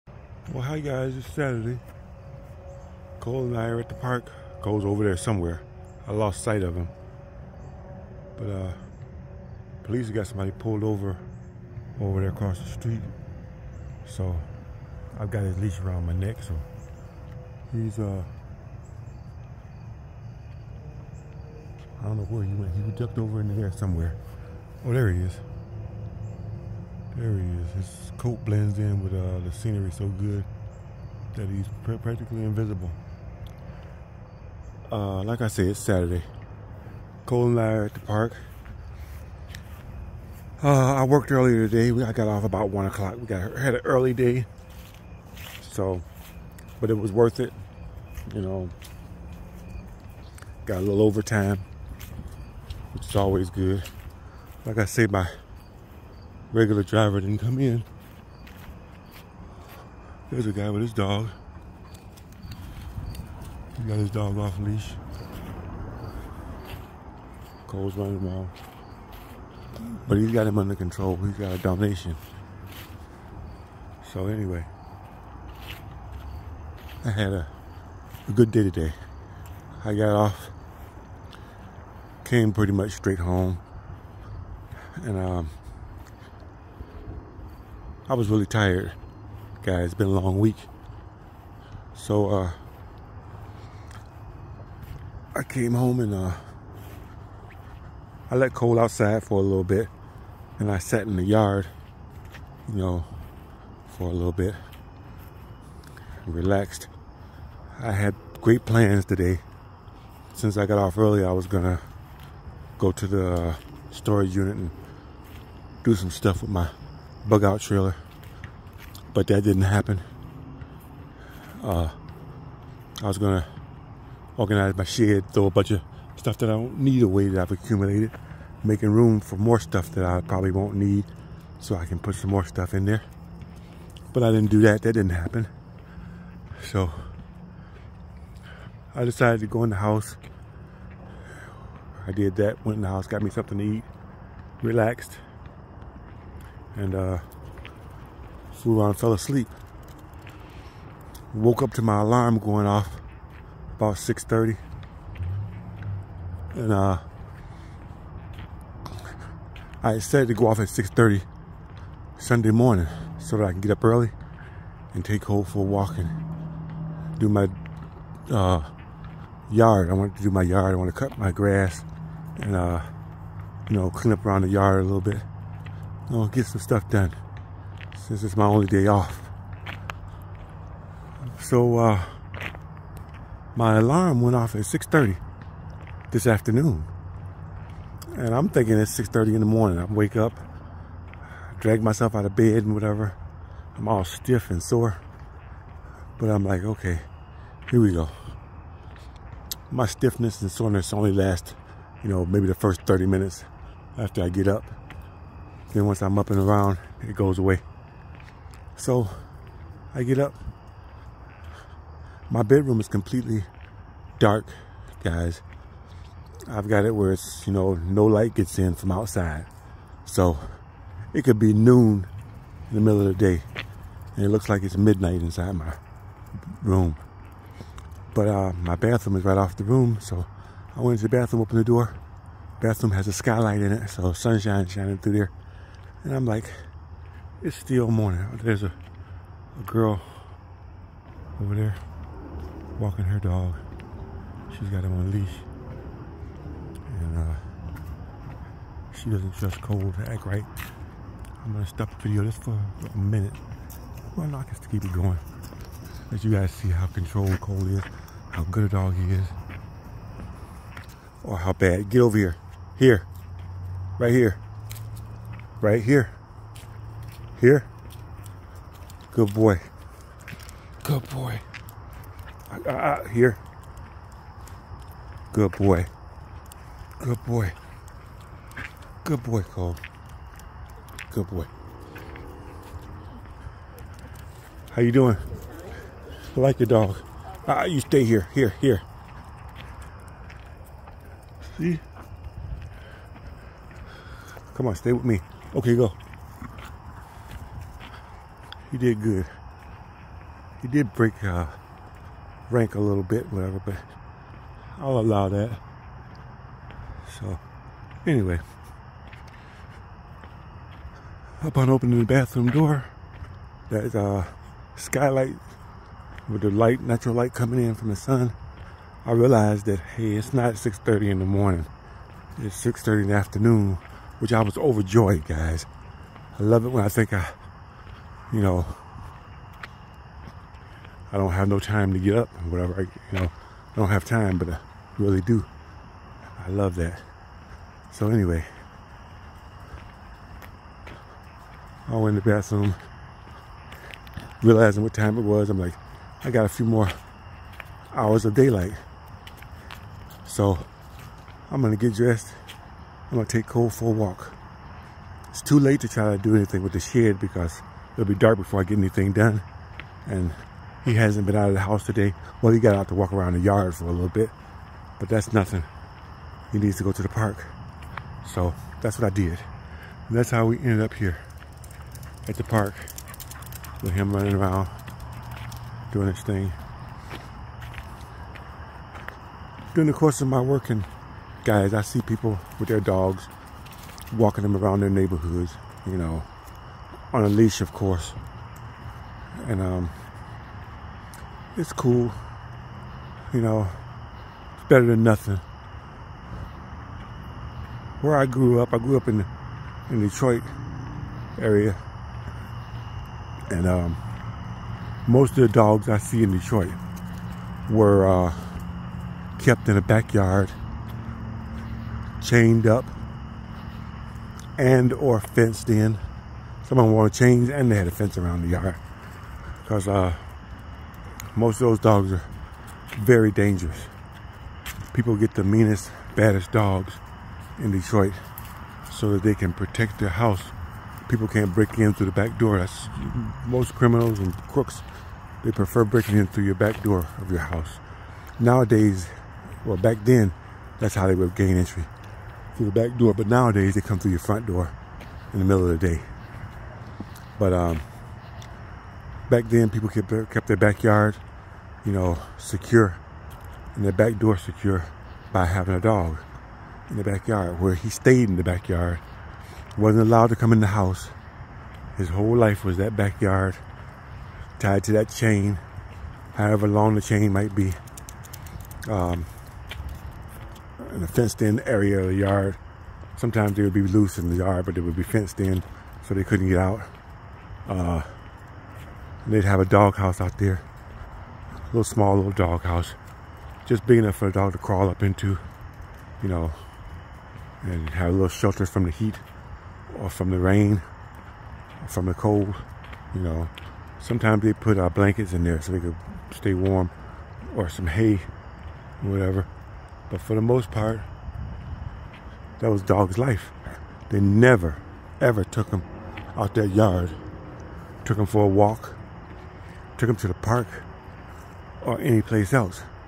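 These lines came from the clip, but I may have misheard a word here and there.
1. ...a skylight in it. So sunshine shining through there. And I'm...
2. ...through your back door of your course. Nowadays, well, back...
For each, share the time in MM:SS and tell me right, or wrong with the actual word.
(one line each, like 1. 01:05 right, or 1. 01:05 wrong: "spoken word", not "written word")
1. 03:53 right
2. 07:16 wrong: "house", not "course".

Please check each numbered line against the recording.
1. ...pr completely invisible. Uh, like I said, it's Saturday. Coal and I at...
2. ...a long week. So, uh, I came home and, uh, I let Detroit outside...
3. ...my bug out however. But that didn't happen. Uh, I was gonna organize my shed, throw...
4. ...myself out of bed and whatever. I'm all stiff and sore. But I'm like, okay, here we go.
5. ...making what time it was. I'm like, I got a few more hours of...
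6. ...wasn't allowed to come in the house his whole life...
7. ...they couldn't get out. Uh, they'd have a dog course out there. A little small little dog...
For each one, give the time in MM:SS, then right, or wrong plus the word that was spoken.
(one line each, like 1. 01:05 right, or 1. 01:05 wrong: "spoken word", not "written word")
1. 00:31 wrong: "practically", not "completely"
2. 01:30 wrong: "Coal", not "Detroit"
3. 01:56 wrong: "trailer", not "however"
4. 03:11 right
5. 05:44 wrong: "realizing", not "making"
6. 07:39 right
7. 07:56 wrong: "house", not "course".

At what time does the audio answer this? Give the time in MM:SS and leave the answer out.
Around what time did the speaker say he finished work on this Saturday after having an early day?
00:42.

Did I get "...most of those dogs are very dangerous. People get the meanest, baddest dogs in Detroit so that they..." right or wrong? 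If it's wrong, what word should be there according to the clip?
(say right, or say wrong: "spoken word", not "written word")
right.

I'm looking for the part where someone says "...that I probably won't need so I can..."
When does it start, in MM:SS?
02:09.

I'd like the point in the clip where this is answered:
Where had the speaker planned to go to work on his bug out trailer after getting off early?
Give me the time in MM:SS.
01:53.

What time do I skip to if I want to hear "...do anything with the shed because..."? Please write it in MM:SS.
05:56.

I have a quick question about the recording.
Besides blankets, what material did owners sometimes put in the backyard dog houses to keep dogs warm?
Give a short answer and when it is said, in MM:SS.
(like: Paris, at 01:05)
hay, at 08:17.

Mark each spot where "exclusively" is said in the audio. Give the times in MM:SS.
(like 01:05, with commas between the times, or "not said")
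not said.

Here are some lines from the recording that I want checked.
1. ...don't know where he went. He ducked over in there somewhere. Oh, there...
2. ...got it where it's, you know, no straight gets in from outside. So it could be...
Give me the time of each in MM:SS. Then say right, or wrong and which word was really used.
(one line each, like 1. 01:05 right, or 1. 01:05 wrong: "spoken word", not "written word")
1. 00:22 right
2. 03:36 wrong: "light", not "straight".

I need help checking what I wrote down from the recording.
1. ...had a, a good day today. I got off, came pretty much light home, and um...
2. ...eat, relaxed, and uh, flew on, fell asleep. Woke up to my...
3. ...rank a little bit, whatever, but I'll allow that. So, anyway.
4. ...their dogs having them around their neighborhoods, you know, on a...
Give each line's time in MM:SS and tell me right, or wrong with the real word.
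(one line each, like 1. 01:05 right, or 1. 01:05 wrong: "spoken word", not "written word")
1. 01:17 wrong: "straight", not "light"
2. 02:23 right
3. 05:02 right
4. 06:22 wrong: "walking", not "having".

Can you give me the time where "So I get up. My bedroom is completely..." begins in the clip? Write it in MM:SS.
03:28.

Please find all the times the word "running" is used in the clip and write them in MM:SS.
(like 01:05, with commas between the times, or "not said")
01:07, 06:14.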